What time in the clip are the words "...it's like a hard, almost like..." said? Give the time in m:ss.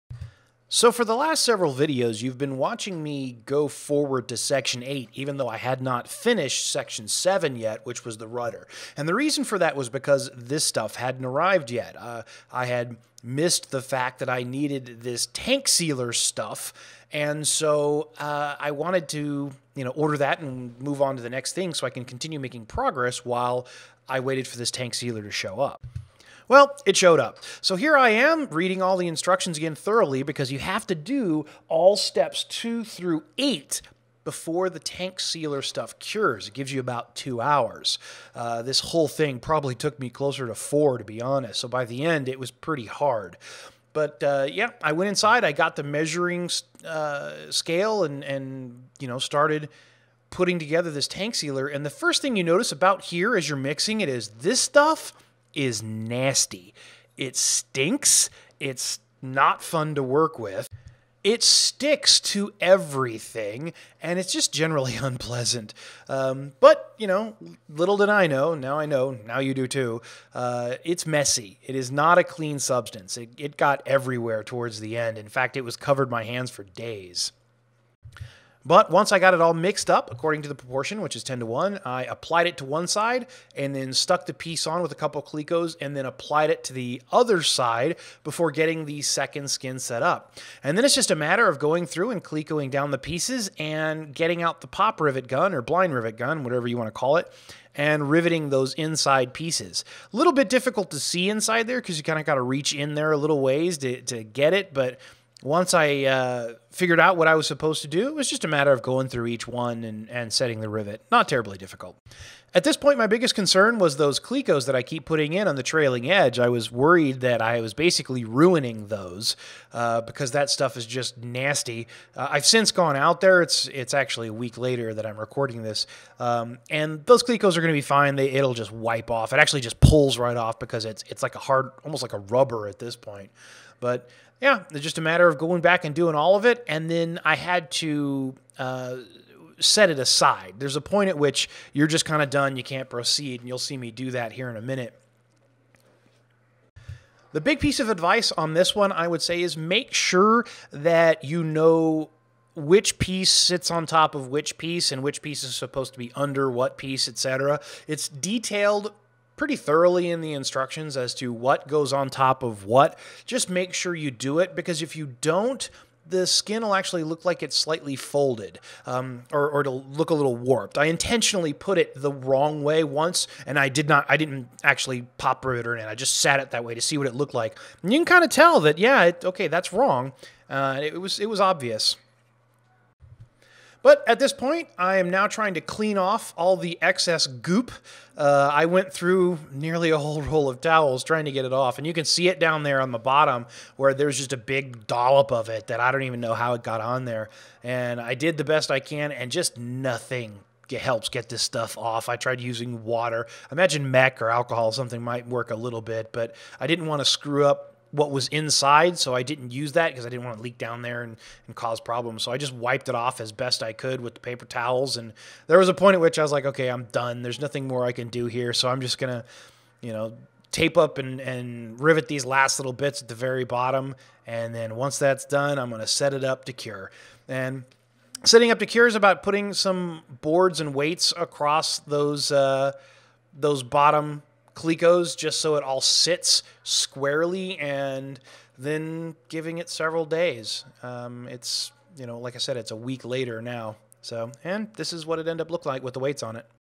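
2:11.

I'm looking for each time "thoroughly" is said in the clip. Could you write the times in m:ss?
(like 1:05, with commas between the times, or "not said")
0:29, 2:39.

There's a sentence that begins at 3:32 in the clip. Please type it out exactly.
So I just wiped it off as best I could with the paper towels.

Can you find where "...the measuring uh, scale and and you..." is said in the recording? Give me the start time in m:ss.
0:45.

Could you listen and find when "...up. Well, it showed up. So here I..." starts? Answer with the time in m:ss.
0:25.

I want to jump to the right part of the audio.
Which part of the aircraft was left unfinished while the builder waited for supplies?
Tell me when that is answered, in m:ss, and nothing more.
0:08.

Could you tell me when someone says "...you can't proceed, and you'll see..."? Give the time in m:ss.
2:22.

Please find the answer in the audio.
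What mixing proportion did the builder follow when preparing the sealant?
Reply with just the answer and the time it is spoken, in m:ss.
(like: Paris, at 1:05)
10 to 1, at 1:21.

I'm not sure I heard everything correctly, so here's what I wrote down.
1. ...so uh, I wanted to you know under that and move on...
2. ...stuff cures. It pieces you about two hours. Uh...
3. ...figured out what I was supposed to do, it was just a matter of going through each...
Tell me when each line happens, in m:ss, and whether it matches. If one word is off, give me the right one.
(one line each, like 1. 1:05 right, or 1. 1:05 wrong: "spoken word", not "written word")
1. 0:17 wrong: "order", not "under"
2. 0:35 wrong: "gives", not "pieces"
3. 1:46 right.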